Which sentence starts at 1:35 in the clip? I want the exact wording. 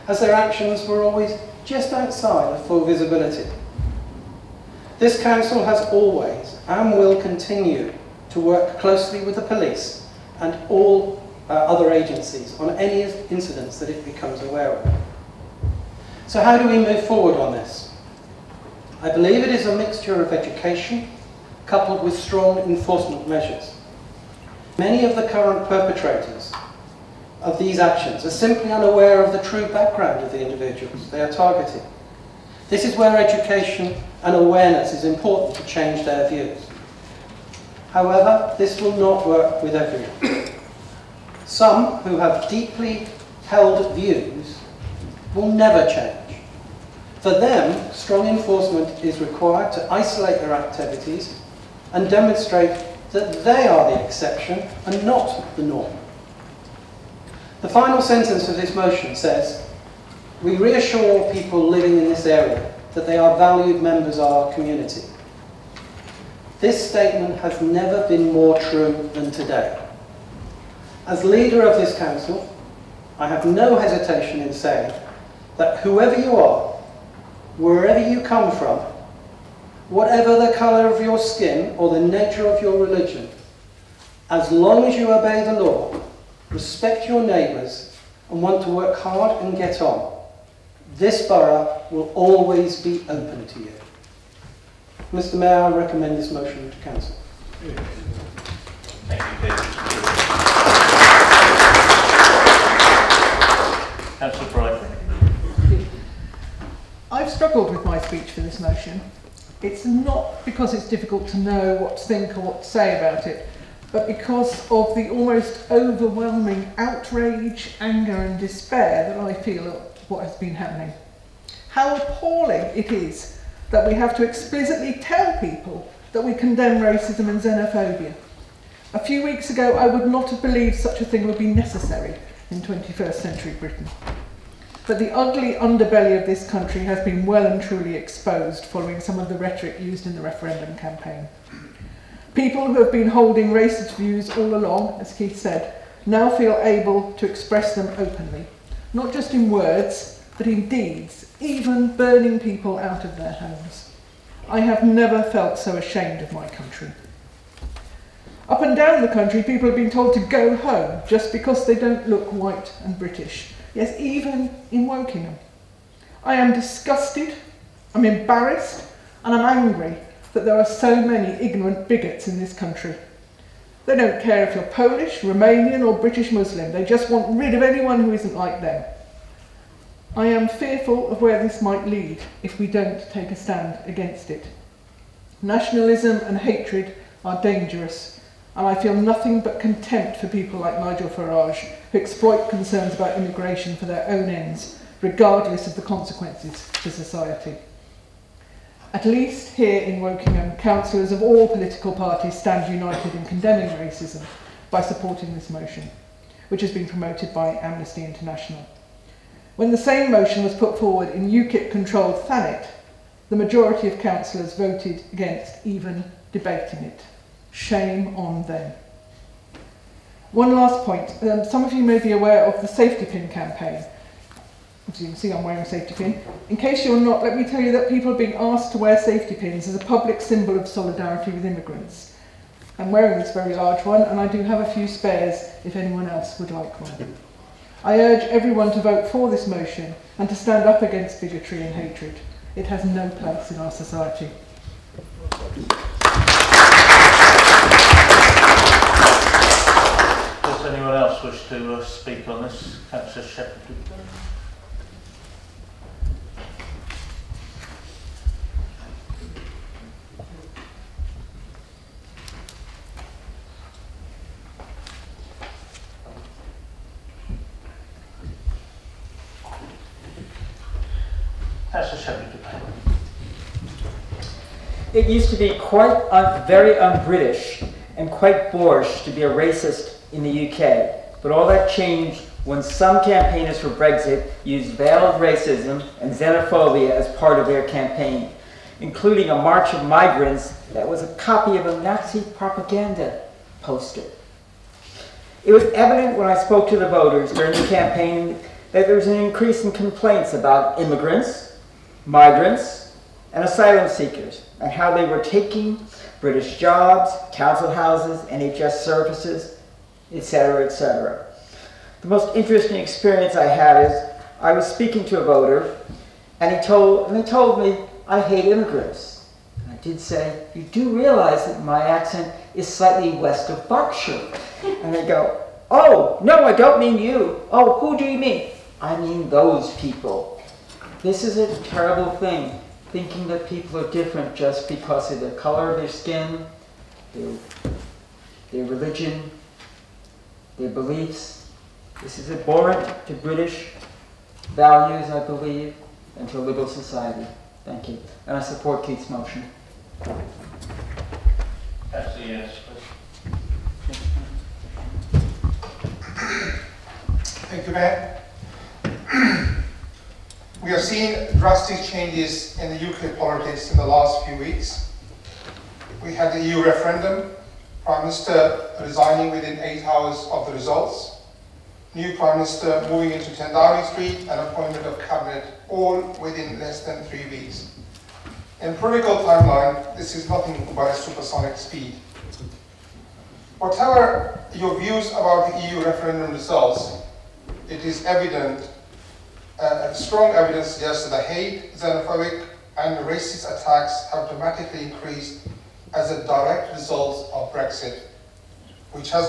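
Mr Mayor, I recommend this motion to Council.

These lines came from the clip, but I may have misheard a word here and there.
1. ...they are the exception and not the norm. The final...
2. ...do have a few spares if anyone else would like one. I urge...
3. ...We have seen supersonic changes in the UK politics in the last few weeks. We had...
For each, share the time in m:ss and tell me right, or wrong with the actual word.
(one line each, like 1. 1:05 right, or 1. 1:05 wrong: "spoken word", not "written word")
1. 0:53 right
2. 3:54 right
3. 6:00 wrong: "drastic", not "supersonic".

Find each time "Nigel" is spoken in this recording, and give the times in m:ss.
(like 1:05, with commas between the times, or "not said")
3:10.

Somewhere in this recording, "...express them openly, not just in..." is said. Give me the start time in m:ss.
2:27.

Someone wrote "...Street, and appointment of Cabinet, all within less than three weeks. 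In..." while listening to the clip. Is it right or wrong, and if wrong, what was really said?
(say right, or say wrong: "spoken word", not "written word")
right.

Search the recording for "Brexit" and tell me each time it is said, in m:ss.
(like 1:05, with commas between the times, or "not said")
4:43, 6:37.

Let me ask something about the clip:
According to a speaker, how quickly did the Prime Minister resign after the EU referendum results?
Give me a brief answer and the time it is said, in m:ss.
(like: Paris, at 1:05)
8 hours, at 6:09.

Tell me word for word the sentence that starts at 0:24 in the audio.
Many of the current perpetrators of these actions are simply unaware of the true background of the individuals they are targeting.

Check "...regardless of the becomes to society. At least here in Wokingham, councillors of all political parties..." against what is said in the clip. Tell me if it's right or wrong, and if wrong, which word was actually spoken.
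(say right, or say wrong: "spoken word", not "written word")
wrong: "consequences", not "becomes".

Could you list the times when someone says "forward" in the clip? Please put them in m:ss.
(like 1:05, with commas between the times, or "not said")
0:17, 3:30.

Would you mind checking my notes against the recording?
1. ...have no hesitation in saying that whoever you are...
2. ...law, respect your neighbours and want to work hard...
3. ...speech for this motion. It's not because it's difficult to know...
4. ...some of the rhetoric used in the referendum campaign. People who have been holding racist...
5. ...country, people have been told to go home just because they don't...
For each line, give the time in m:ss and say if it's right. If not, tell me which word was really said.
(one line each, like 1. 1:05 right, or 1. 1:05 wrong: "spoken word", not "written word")
1. 1:13 right
2. 1:25 right
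3. 1:47 right
4. 2:19 right
5. 2:39 right.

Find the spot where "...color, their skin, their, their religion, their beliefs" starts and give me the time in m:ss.
5:35.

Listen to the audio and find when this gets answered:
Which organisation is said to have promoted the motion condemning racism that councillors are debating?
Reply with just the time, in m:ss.
3:27.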